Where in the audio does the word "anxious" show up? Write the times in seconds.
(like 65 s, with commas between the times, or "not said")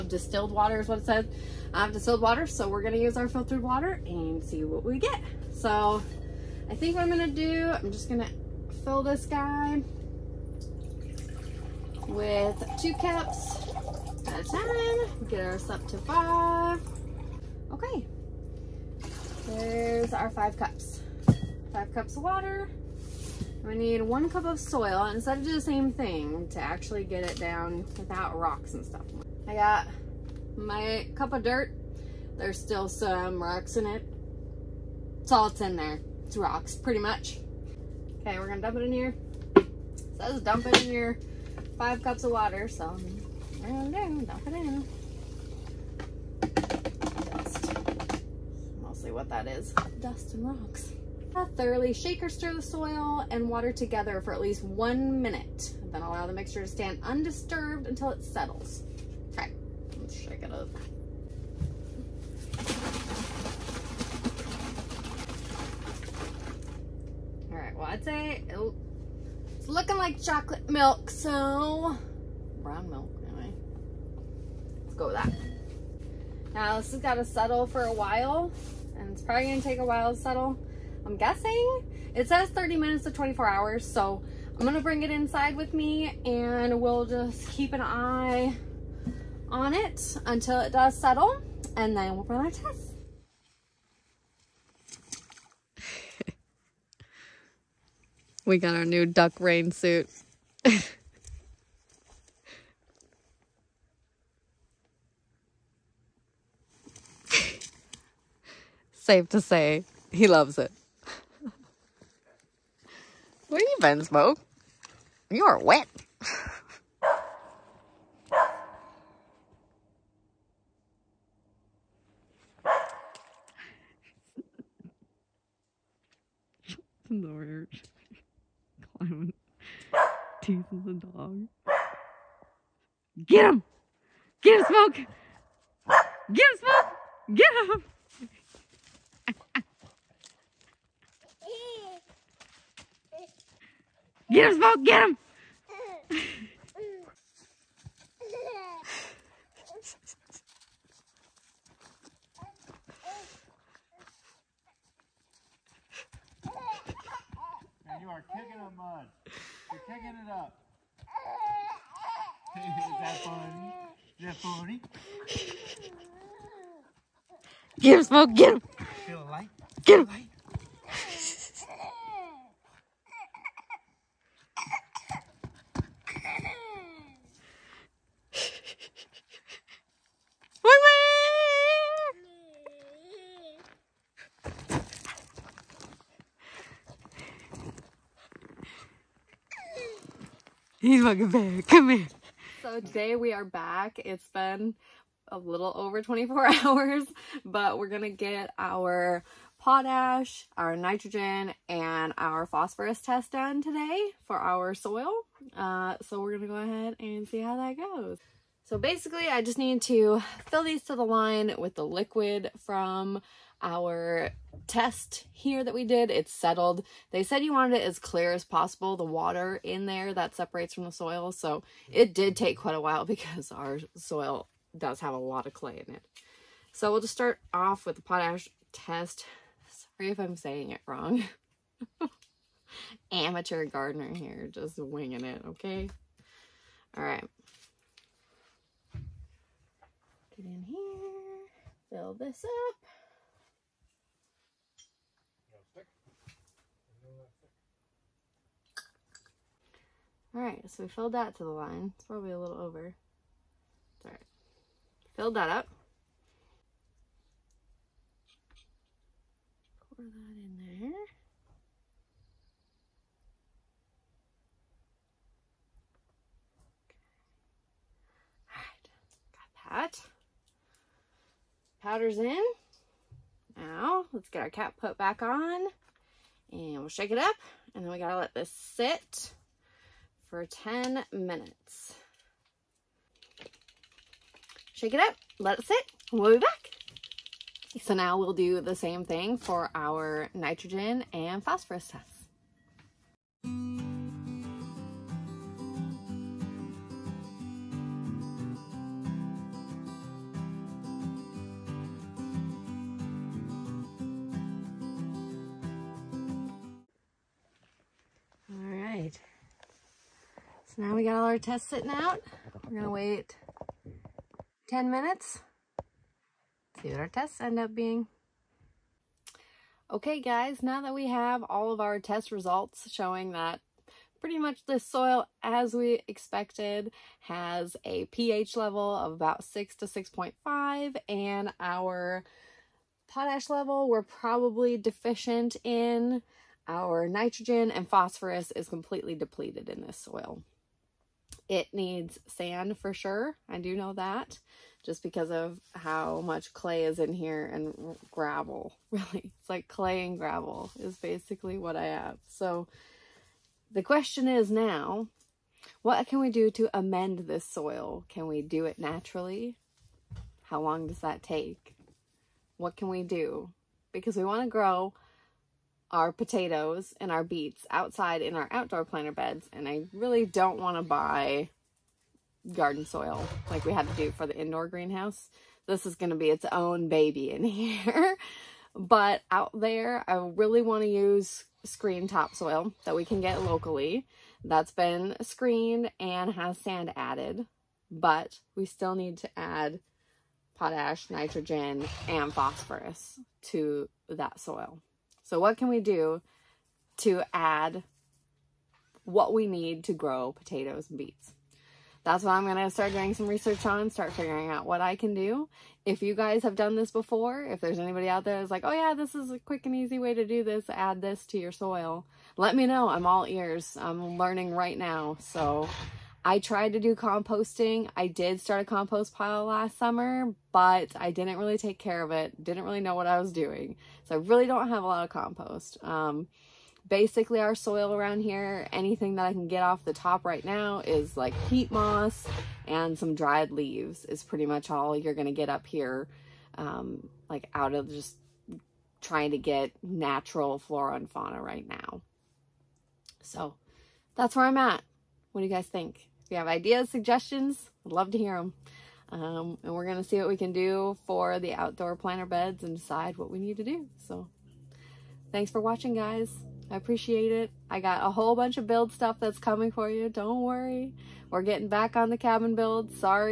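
not said.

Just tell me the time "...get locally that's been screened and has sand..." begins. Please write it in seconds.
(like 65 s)
383 s.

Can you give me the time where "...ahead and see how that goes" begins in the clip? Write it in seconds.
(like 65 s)
206 s.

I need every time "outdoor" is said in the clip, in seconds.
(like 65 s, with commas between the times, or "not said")
368 s, 451 s.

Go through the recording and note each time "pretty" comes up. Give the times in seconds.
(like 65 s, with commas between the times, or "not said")
36 s, 324 s, 434 s.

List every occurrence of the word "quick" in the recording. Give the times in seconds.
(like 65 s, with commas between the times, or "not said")
409 s.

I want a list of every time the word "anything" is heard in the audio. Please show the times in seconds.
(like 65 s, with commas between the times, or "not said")
428 s.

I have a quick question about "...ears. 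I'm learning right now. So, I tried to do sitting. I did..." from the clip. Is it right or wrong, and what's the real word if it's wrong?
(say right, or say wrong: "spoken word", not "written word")
wrong: "composting", not "sitting".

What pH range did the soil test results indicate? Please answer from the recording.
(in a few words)
6 to 6.5.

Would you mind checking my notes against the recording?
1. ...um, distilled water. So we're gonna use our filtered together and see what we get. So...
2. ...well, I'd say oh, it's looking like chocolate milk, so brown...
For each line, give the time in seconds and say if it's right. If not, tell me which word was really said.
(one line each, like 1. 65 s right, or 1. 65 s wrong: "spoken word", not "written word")
1. 1 s wrong: "water", not "together"
2. 67 s right.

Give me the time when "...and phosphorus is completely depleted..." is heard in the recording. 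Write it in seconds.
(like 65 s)
337 s.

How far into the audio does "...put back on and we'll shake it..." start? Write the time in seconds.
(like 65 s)
274 s.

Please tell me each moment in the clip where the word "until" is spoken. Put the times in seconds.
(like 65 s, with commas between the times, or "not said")
57 s, 90 s.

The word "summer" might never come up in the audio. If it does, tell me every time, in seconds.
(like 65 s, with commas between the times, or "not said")
419 s.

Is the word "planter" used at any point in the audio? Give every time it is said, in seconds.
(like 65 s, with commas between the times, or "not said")
368 s, 451 s.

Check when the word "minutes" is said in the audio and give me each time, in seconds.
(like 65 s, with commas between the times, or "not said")
55 s, 82 s, 281 s, 314 s.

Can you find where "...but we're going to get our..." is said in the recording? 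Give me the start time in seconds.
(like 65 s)
197 s.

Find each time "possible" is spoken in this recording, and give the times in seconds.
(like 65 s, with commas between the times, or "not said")
218 s.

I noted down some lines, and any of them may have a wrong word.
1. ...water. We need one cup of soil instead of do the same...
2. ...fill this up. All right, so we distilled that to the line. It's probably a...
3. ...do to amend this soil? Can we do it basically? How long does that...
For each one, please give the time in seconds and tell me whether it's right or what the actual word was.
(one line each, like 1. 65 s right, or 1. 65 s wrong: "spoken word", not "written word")
1. 22 s right
2. 241 s wrong: "filled", not "distilled"
3. 356 s wrong: "naturally", not "basically".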